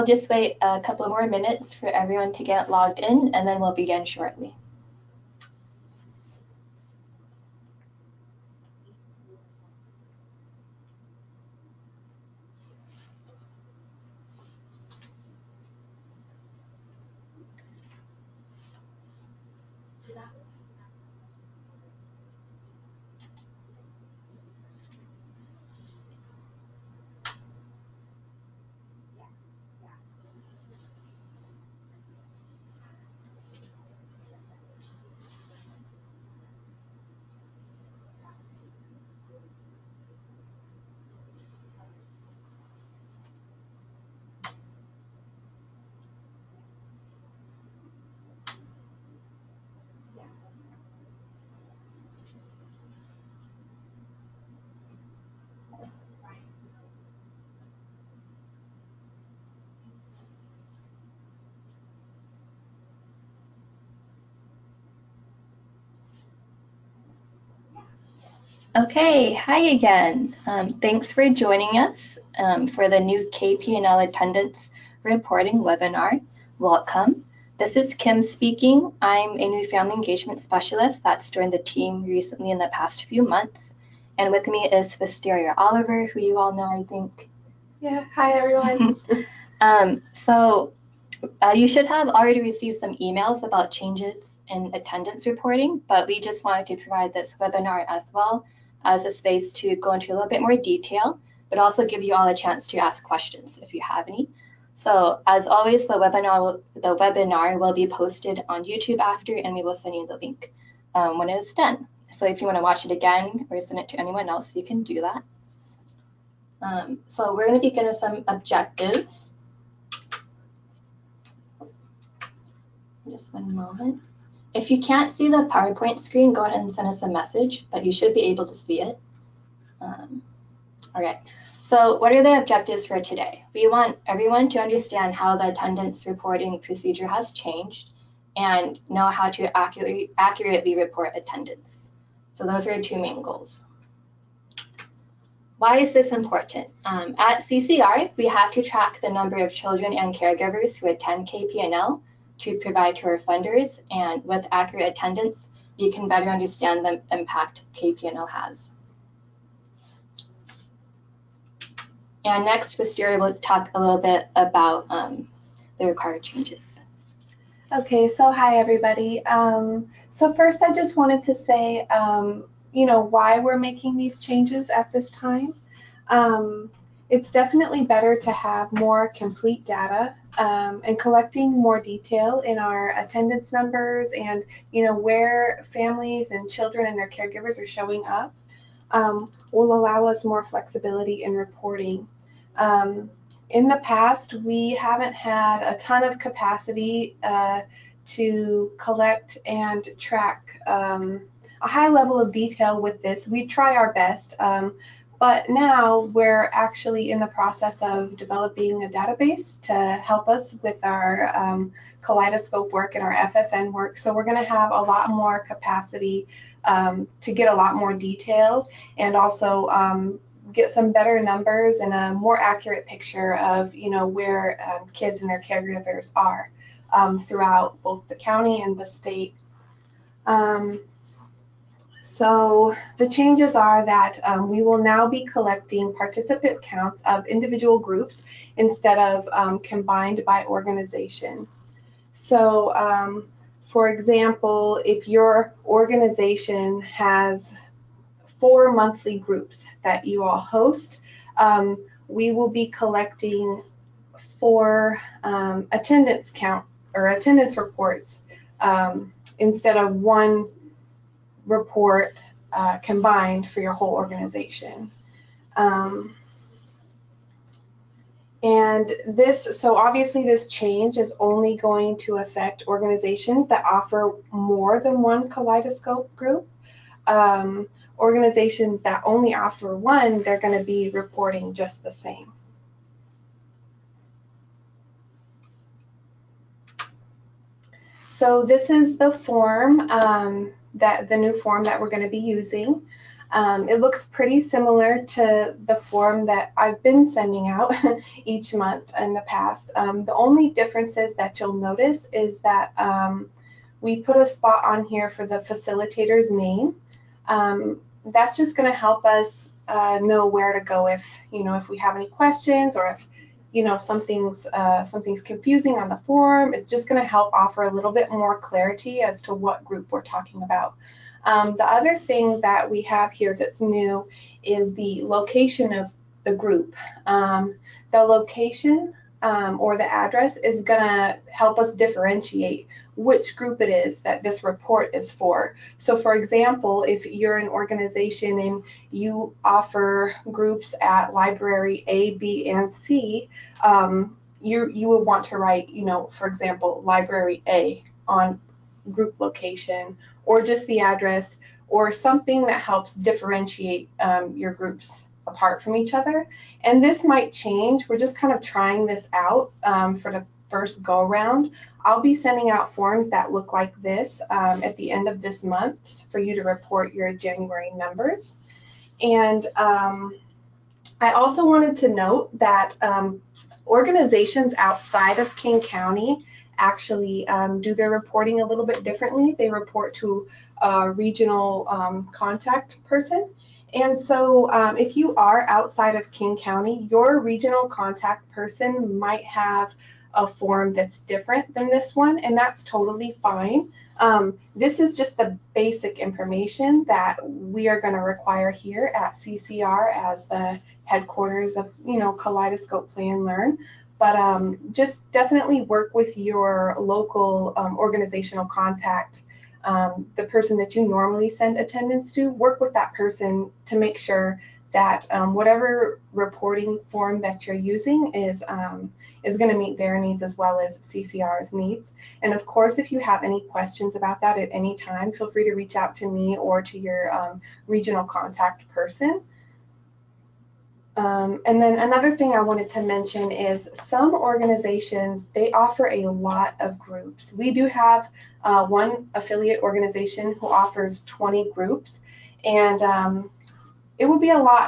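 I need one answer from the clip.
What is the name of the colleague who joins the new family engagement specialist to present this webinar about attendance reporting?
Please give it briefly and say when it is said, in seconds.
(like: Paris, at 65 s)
Wisteria Oliver, at 84 s.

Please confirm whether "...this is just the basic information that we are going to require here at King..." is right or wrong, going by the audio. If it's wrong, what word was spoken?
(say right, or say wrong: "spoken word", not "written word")
wrong: "CCR", not "King".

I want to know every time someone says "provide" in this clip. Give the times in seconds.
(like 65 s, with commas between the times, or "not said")
96 s, 152 s.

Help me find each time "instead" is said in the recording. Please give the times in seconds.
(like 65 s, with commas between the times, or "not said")
238 s, 259 s.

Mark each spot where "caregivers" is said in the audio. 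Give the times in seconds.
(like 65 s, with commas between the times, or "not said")
150 s, 187 s, 225 s.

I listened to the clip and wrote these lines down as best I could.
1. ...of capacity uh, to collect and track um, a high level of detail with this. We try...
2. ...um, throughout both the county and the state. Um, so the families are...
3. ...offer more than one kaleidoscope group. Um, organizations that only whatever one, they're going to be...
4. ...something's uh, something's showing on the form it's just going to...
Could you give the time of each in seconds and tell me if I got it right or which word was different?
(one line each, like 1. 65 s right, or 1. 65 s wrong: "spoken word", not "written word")
1. 196 s right
2. 226 s wrong: "changes", not "families"
3. 273 s wrong: "offer", not "whatever"
4. 313 s wrong: "confusing", not "showing".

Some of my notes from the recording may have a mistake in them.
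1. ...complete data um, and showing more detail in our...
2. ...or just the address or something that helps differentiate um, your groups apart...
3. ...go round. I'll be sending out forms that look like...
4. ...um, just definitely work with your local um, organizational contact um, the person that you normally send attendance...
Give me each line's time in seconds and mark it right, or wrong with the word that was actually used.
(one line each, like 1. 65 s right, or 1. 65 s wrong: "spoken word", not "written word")
1. 179 s wrong: "collecting", not "showing"
2. 350 s right
3. 360 s right
4. 404 s right.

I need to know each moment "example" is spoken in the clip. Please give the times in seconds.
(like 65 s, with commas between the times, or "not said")
243 s, 336 s, 346 s.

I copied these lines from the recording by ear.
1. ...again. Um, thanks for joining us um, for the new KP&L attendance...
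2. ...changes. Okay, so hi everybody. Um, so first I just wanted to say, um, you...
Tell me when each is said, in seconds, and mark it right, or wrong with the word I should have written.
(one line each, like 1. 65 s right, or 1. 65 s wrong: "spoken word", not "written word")
1. 69 s right
2. 166 s right.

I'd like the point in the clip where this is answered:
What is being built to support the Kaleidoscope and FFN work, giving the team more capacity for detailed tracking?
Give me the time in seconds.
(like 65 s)
208 s.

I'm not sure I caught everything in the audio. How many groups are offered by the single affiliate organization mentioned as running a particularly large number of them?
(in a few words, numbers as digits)
20.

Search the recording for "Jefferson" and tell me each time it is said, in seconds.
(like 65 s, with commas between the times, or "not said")
not said.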